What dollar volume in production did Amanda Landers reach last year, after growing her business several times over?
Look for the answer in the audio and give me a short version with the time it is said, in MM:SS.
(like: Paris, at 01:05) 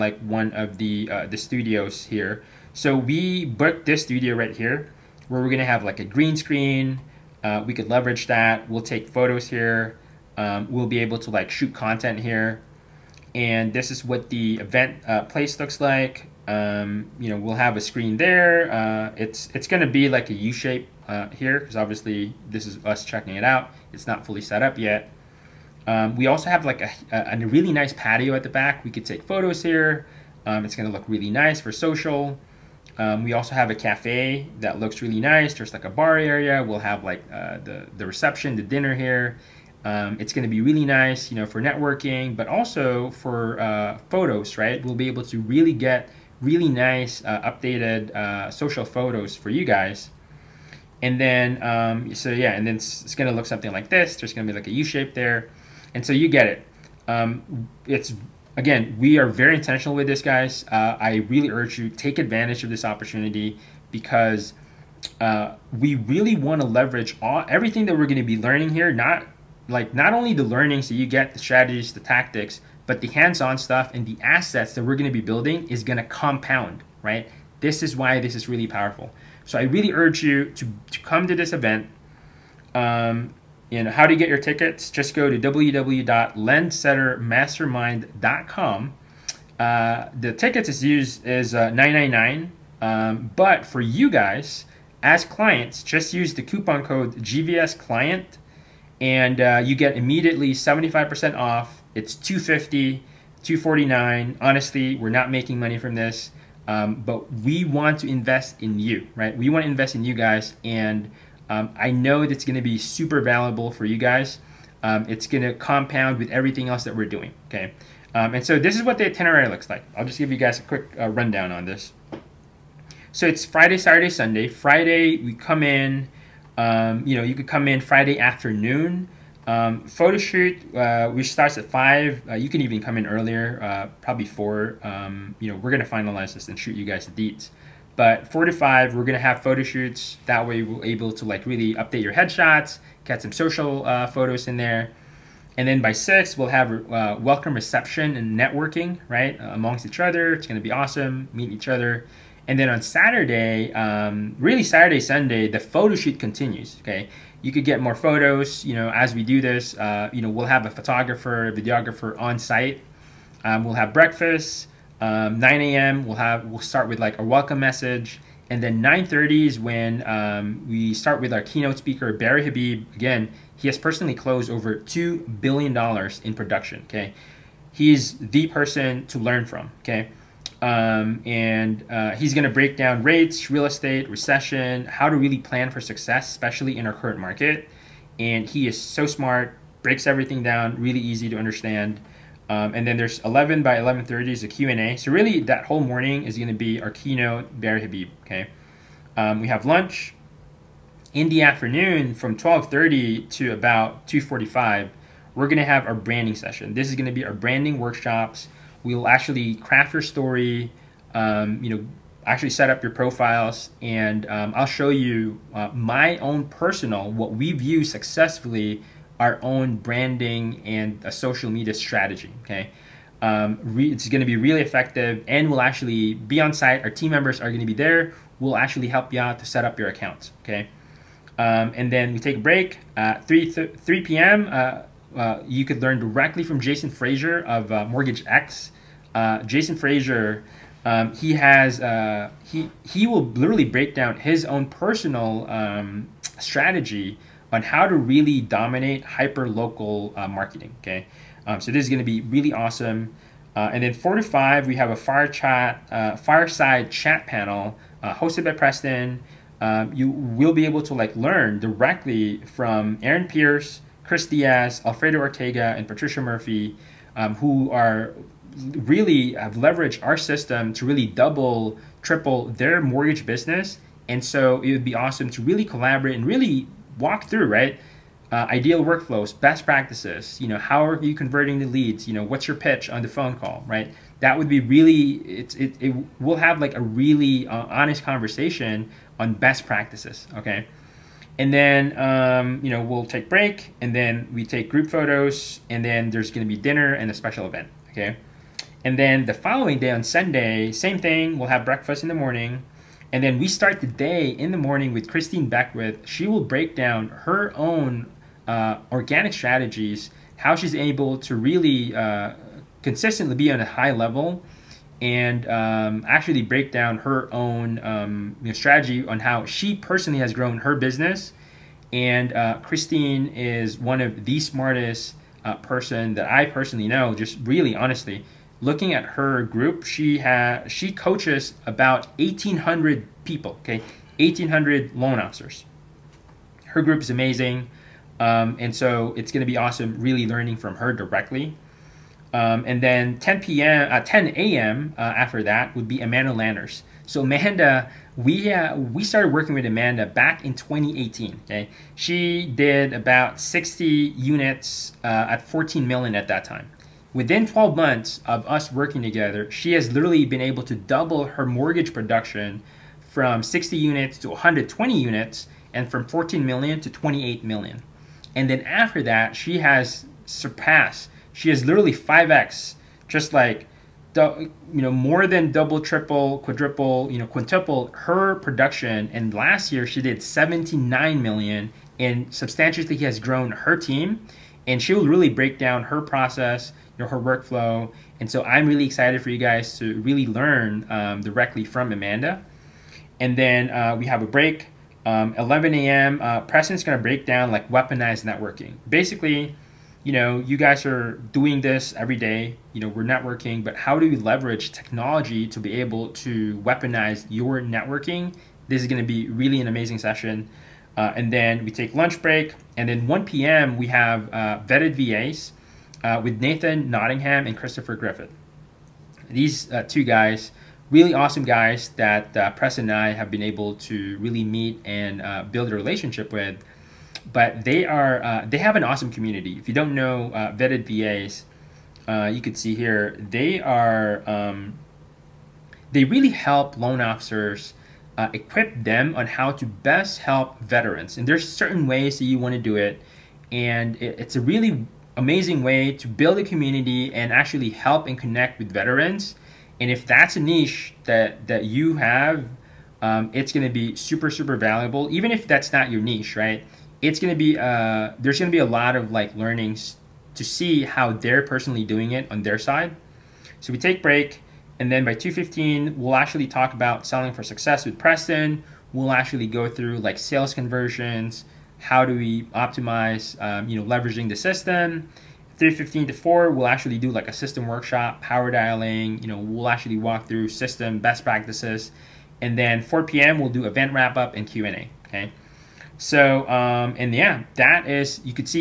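79 million, at 06:20.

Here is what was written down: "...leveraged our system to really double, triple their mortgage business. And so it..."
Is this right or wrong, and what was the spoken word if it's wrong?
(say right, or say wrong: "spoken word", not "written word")
right.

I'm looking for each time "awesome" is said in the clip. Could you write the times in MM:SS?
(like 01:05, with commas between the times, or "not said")
02:30, 04:12, 04:34, 05:39, 07:01, 07:08.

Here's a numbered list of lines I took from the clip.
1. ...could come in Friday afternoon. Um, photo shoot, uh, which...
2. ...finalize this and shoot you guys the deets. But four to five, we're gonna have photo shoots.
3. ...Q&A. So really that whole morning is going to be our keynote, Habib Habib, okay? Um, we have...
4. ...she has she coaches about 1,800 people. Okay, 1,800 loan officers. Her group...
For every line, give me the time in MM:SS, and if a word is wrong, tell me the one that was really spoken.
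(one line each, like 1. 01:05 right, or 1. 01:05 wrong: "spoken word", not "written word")
1. 02:07 right
2. 02:15 right
3. 03:14 wrong: "Barry", not "Habib"
4. 05:29 right.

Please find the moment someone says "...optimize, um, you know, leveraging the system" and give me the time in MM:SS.
07:52.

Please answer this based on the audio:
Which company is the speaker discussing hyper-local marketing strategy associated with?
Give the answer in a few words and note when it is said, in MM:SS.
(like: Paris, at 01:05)
Mortgage X, at 03:57.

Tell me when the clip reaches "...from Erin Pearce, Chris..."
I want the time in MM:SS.
04:22.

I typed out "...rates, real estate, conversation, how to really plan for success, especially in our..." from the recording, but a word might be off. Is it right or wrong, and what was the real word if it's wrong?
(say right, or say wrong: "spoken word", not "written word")
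wrong: "recession", not "conversation".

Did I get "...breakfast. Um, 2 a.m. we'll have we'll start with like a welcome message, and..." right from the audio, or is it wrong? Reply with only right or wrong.
wrong.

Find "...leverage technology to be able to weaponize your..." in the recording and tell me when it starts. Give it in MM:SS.
06:44.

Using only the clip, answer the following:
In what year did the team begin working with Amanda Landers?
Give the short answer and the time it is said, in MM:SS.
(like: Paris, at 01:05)
2018, at 05:50.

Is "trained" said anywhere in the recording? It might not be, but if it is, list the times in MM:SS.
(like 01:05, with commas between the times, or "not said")
not said.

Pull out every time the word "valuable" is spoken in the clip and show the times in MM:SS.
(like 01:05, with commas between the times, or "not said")
01:53, 07:34.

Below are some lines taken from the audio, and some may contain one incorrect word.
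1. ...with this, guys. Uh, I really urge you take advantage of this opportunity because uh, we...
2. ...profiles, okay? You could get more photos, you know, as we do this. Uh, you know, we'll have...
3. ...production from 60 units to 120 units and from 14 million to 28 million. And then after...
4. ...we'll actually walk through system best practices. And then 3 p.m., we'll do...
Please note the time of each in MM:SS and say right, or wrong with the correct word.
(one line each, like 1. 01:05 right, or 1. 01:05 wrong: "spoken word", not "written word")
1. 00:59 right
2. 02:36 wrong: "continues", not "profiles"
3. 06:01 right
4. 07:59 wrong: "4", not "3".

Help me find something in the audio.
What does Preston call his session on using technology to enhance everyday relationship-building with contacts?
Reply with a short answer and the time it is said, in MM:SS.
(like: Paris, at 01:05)
weaponized networking, at 06:37.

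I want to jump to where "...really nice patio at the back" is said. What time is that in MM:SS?
00:27.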